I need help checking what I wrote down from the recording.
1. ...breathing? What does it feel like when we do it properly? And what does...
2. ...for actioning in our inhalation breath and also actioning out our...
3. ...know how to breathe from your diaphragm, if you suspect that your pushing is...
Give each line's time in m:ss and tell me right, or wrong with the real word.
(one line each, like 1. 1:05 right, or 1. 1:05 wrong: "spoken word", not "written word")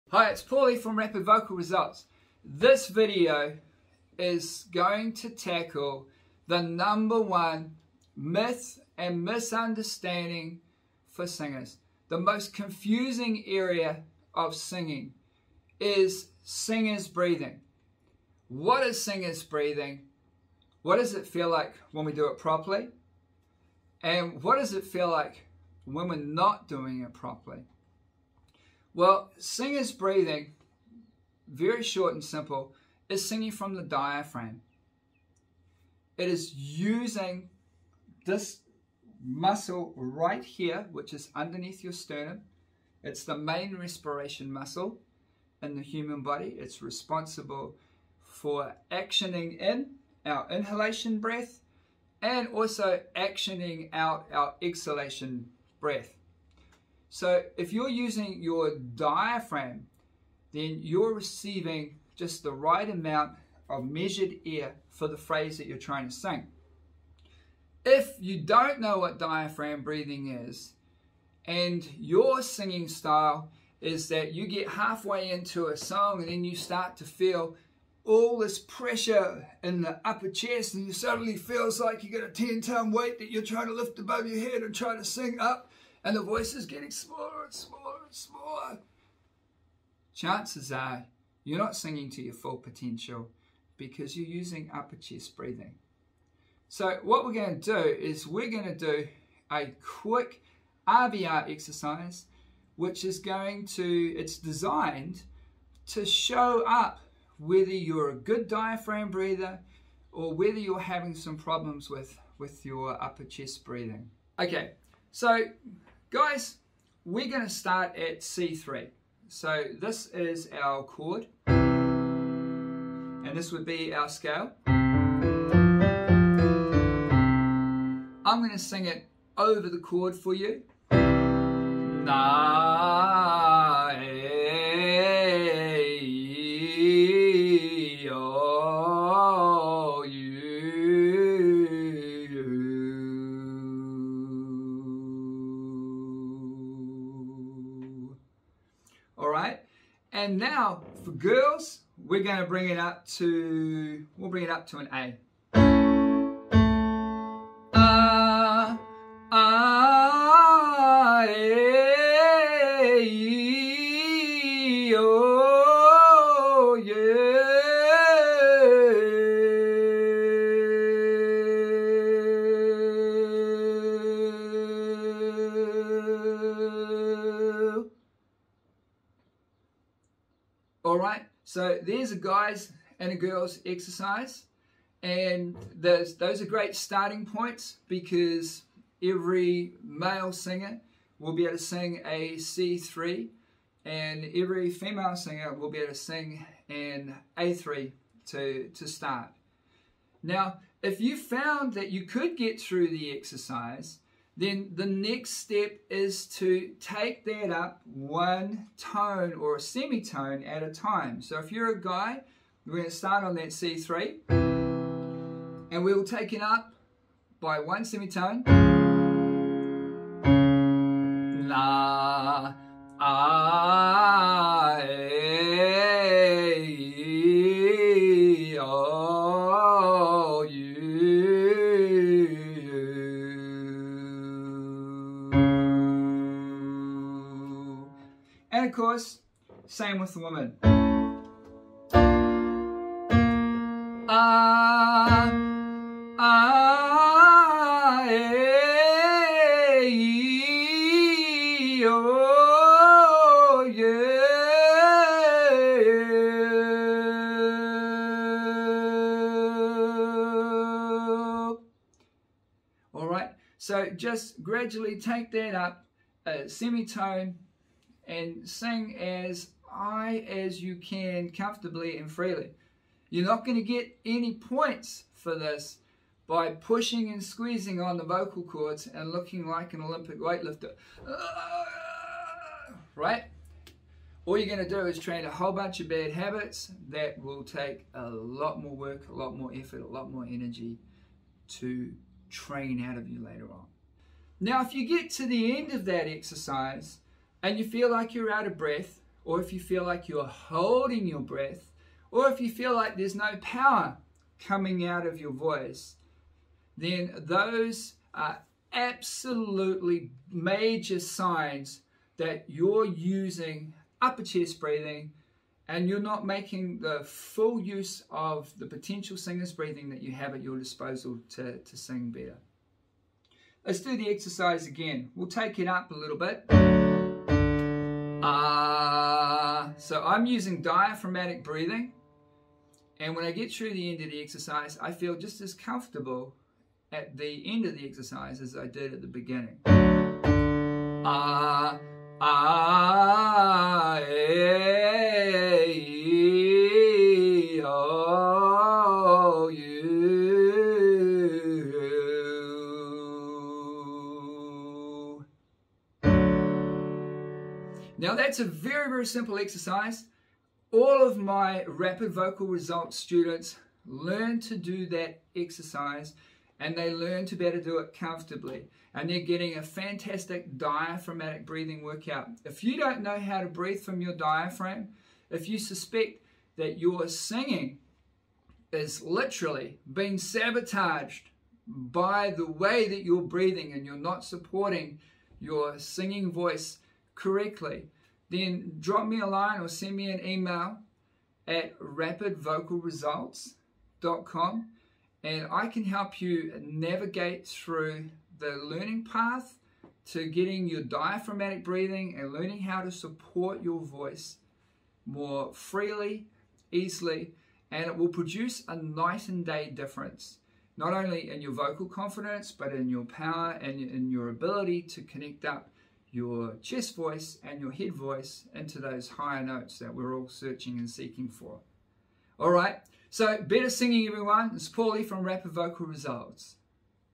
1. 0:19 right
2. 0:48 right
3. 6:13 wrong: "singing", not "pushing".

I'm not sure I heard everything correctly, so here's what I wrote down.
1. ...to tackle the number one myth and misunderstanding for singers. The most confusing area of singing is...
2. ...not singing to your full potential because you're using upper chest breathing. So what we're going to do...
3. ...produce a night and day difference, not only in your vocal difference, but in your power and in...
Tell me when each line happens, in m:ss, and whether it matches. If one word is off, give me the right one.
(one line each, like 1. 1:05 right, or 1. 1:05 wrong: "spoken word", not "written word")
1. 0:05 right
2. 1:31 right
3. 6:48 wrong: "confidence", not "difference".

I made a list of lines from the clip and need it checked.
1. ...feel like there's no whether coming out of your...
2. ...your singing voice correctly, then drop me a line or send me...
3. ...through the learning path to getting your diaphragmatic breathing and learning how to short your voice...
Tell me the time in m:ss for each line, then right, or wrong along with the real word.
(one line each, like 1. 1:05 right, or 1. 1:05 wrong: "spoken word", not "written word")
1. 5:02 wrong: "power", not "whether"
2. 6:25 right
3. 6:37 wrong: "support", not "short".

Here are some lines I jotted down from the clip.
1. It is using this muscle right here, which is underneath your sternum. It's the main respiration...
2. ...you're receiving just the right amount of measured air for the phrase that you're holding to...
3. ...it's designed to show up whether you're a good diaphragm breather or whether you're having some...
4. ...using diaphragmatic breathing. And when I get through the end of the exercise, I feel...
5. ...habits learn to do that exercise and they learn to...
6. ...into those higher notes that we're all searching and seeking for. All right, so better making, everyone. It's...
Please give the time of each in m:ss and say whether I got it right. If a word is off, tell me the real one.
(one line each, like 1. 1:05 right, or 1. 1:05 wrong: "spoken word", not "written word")
1. 0:36 right
2. 1:00 wrong: "trying", not "holding"
3. 1:44 right
4. 5:30 right
5. 6:02 wrong: "students", not "habits"
6. 6:58 wrong: "singing", not "making".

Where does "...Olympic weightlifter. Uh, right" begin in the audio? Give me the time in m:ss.
4:39.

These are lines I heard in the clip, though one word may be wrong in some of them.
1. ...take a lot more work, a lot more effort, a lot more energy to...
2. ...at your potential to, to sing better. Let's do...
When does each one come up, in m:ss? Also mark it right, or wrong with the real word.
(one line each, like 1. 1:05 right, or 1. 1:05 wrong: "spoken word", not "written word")
1. 4:47 right
2. 5:20 wrong: "disposal", not "potential".